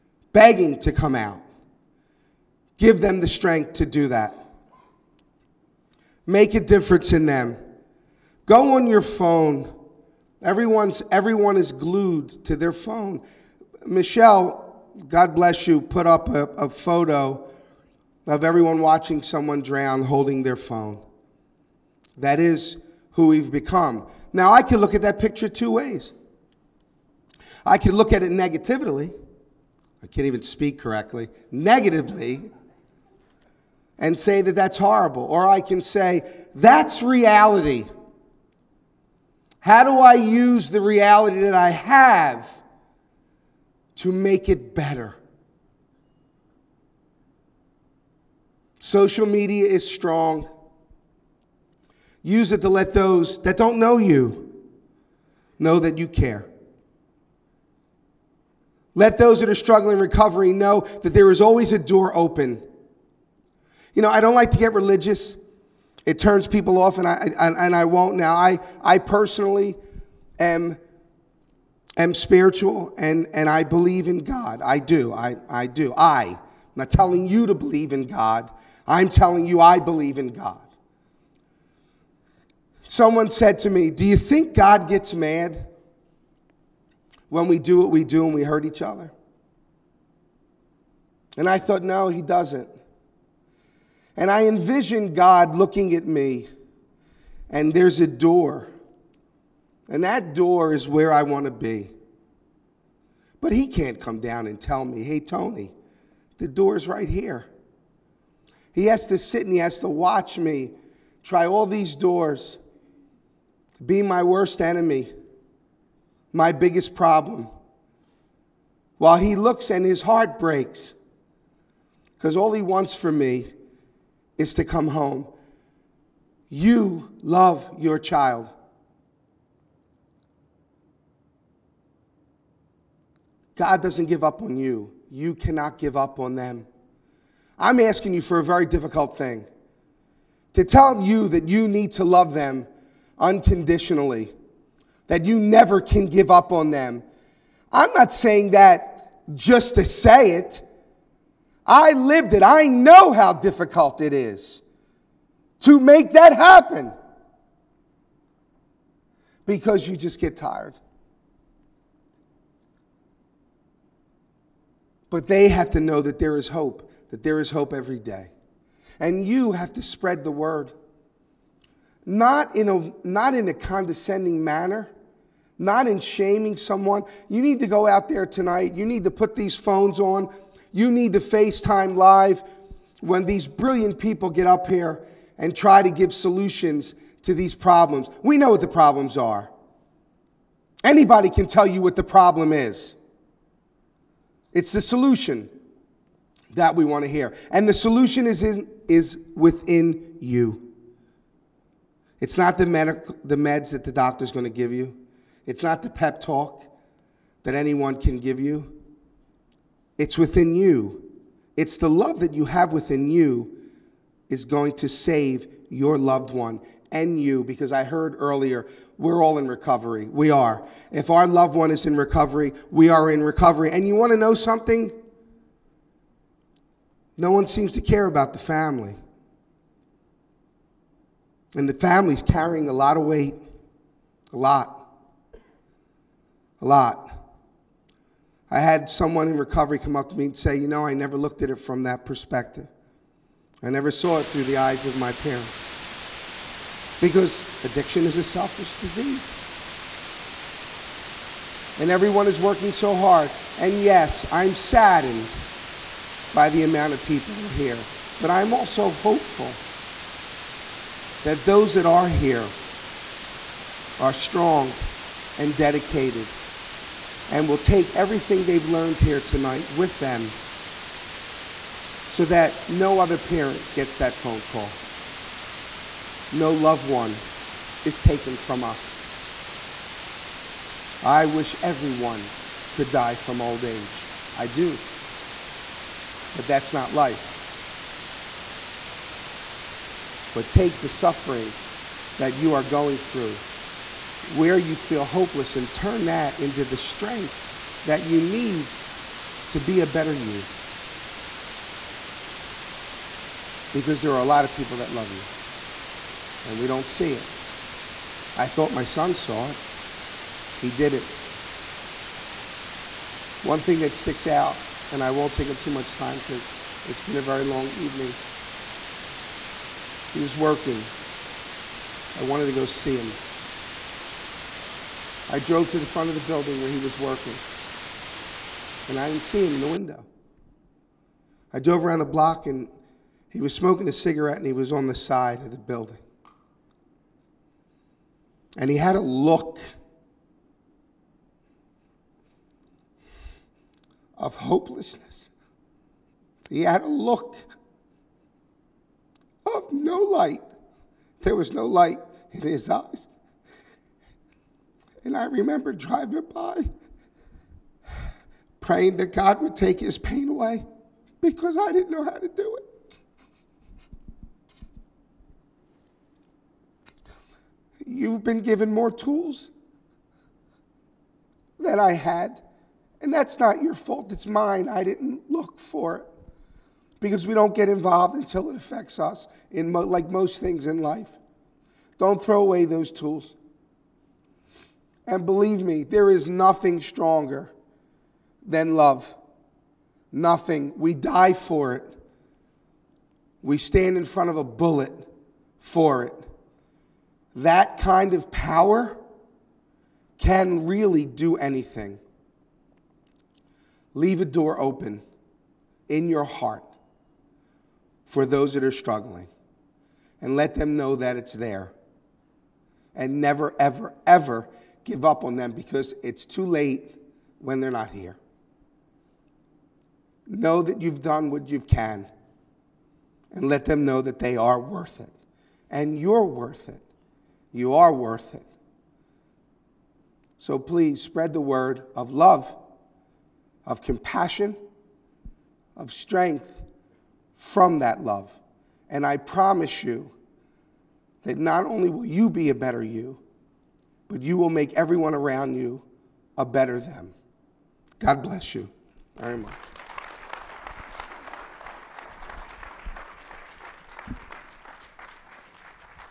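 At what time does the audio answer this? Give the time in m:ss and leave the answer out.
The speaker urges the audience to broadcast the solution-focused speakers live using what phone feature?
3:01.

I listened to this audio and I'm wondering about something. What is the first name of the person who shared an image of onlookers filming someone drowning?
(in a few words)
Michelle.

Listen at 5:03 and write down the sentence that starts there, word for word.
Because there are a lot of people that love you, and we don't see it.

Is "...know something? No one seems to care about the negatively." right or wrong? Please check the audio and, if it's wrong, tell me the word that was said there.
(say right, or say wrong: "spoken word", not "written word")
wrong: "family", not "negatively".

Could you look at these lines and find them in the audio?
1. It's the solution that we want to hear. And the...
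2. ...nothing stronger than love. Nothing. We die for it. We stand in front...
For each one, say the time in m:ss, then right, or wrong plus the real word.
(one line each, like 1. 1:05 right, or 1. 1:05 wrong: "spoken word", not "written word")
1. 3:14 right
2. 6:26 right.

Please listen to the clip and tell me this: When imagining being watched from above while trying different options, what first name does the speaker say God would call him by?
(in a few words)
Tony.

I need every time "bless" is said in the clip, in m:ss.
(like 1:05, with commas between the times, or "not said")
0:15, 7:28.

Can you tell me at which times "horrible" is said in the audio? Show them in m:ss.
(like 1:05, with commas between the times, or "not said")
0:34.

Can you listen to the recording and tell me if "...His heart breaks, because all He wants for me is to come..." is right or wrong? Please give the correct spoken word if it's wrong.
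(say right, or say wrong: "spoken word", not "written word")
right.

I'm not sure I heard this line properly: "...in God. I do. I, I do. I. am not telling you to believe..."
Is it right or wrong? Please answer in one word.
right.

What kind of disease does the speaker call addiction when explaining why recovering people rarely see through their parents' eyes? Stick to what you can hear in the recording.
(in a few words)
selfish.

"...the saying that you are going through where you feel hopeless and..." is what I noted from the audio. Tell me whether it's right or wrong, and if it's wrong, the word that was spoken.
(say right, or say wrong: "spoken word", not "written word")
wrong: "suffering", not "saying".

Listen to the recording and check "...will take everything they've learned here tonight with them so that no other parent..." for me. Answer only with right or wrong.
right.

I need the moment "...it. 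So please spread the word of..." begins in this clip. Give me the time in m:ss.
7:08.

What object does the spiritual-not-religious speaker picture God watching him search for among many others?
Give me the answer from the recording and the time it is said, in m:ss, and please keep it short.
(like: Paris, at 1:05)
the door, at 1:46.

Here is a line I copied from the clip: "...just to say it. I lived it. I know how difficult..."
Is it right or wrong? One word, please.
right.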